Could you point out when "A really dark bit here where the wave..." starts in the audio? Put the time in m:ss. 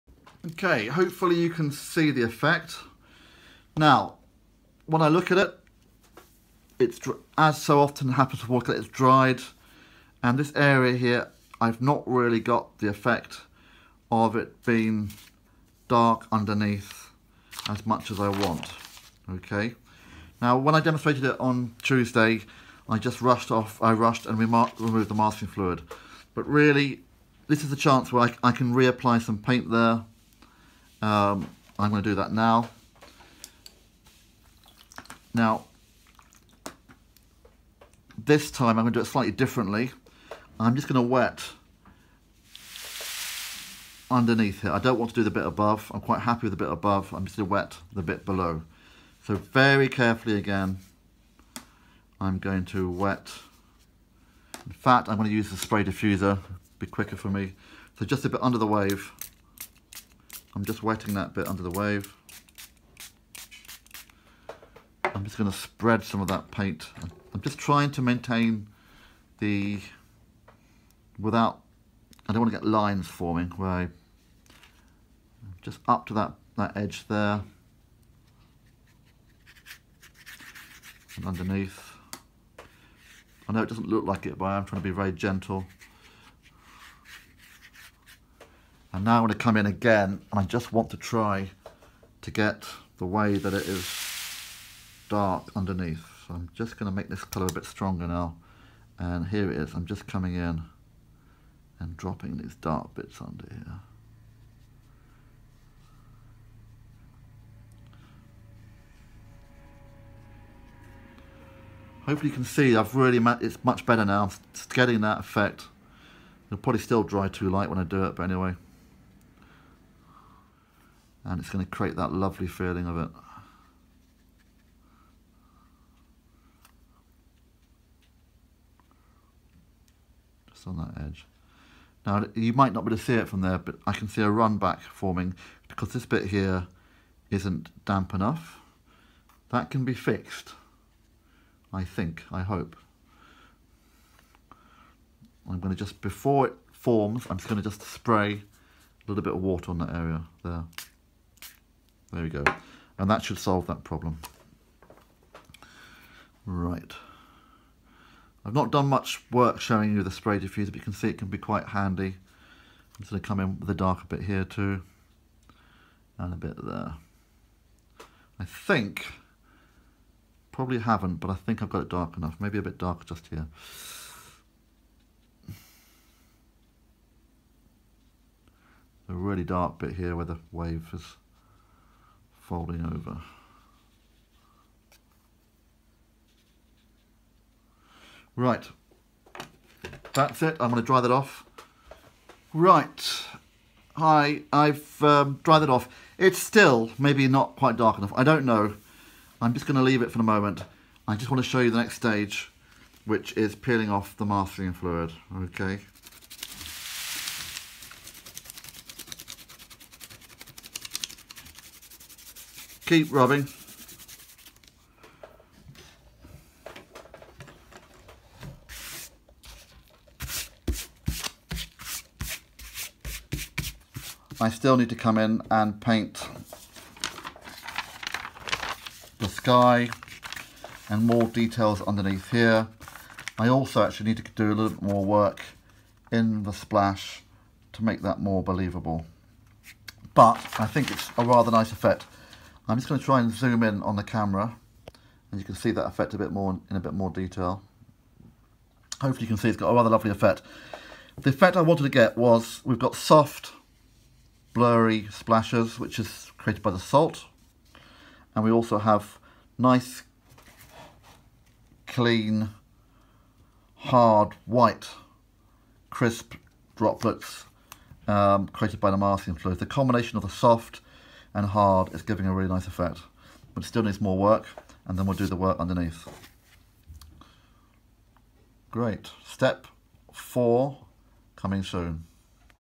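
2:59.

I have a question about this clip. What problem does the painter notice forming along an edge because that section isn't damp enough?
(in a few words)
a run back.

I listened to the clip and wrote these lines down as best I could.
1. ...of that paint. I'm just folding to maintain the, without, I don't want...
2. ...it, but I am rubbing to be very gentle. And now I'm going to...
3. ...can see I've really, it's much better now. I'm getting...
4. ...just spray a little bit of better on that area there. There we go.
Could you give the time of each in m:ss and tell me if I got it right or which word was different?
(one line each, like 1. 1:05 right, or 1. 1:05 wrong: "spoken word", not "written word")
1. 1:06 wrong: "trying", not "folding"
2. 1:24 wrong: "trying", not "rubbing"
3. 1:52 right
4. 2:27 wrong: "water", not "better".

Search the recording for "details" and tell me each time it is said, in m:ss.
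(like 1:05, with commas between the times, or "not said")
3:51, 4:07.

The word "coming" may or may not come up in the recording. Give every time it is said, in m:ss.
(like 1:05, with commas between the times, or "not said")
1:40, 4:41.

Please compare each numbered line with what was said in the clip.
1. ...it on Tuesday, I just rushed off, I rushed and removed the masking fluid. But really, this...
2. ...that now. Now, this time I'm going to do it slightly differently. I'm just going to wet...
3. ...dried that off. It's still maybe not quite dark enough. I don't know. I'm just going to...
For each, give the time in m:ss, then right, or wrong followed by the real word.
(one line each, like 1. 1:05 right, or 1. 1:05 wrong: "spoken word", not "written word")
1. 0:21 right
2. 0:32 right
3. 3:15 right.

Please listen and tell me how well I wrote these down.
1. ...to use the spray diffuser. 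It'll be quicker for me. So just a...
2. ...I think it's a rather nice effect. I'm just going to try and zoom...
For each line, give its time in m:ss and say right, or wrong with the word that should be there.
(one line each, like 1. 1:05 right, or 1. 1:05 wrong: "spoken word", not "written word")
1. 0:55 right
2. 4:00 right.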